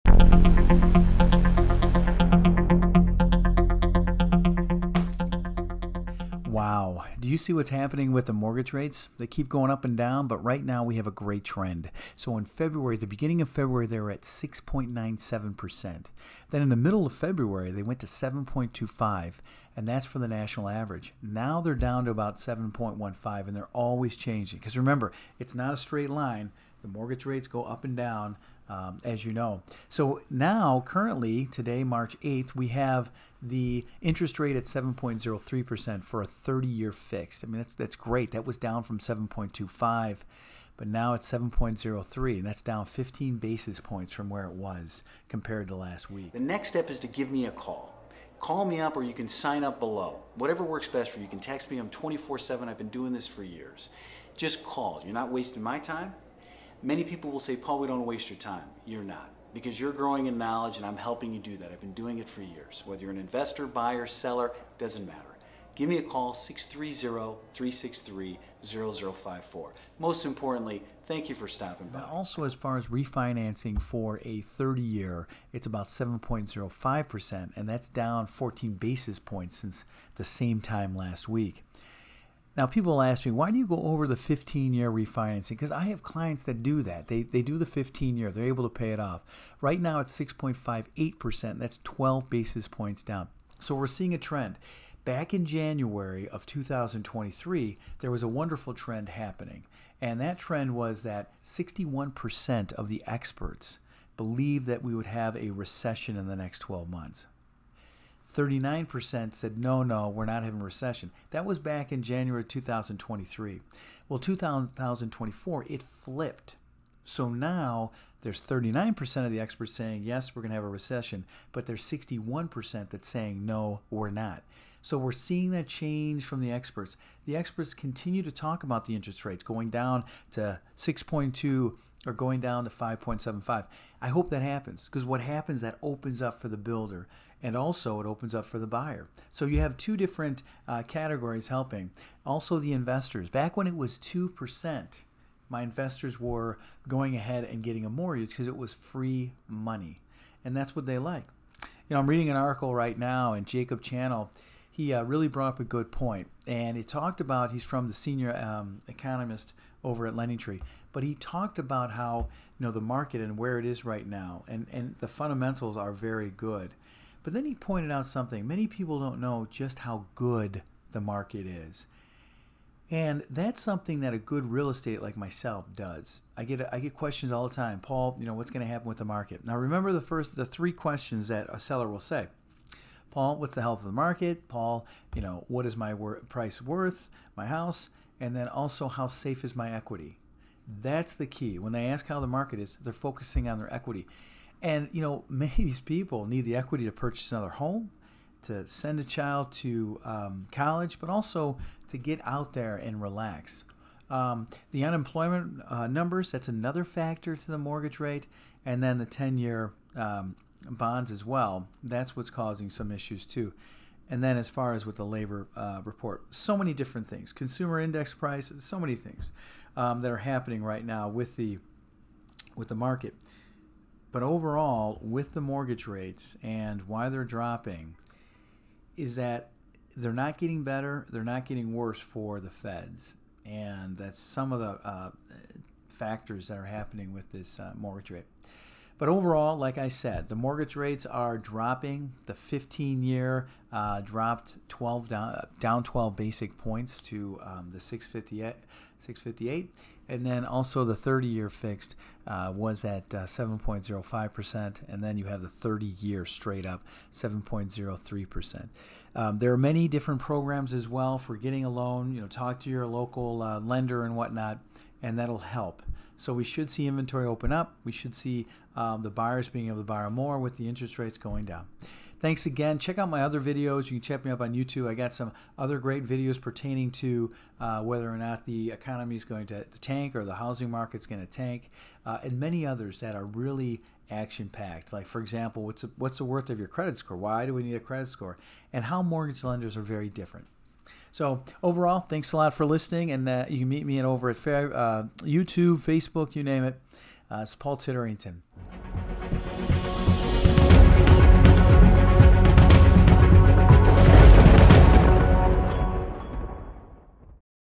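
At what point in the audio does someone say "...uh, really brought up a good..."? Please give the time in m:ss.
2:34.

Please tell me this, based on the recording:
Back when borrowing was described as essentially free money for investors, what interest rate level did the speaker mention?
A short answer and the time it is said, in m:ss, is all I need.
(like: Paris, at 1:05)
2%, at 2:23.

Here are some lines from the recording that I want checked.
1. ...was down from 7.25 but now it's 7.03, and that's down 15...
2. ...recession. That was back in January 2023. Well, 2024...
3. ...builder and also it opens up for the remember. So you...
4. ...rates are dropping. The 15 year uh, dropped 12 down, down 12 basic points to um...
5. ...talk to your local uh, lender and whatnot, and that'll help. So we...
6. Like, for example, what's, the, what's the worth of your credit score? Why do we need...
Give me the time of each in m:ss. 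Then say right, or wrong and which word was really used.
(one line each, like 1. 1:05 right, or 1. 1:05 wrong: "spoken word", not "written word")
1. 0:38 right
2. 1:50 right
3. 2:16 wrong: "buyer", not "remember"
4. 4:00 right
5. 4:22 right
6. 4:44 right.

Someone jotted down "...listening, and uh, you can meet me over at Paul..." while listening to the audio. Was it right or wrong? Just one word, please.
wrong.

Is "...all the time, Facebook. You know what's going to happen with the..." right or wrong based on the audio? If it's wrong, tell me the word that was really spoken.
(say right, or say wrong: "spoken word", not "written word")
wrong: "Paul", not "Facebook".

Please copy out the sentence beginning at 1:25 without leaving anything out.
Because I have clients that do that.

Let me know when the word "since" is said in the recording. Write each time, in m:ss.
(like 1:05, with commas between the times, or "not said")
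1:19.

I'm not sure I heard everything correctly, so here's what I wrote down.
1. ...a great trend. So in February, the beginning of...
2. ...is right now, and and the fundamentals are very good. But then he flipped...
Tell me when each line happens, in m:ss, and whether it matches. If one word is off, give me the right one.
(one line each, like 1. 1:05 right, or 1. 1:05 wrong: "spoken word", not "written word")
1. 0:11 right
2. 2:43 wrong: "pointed", not "flipped".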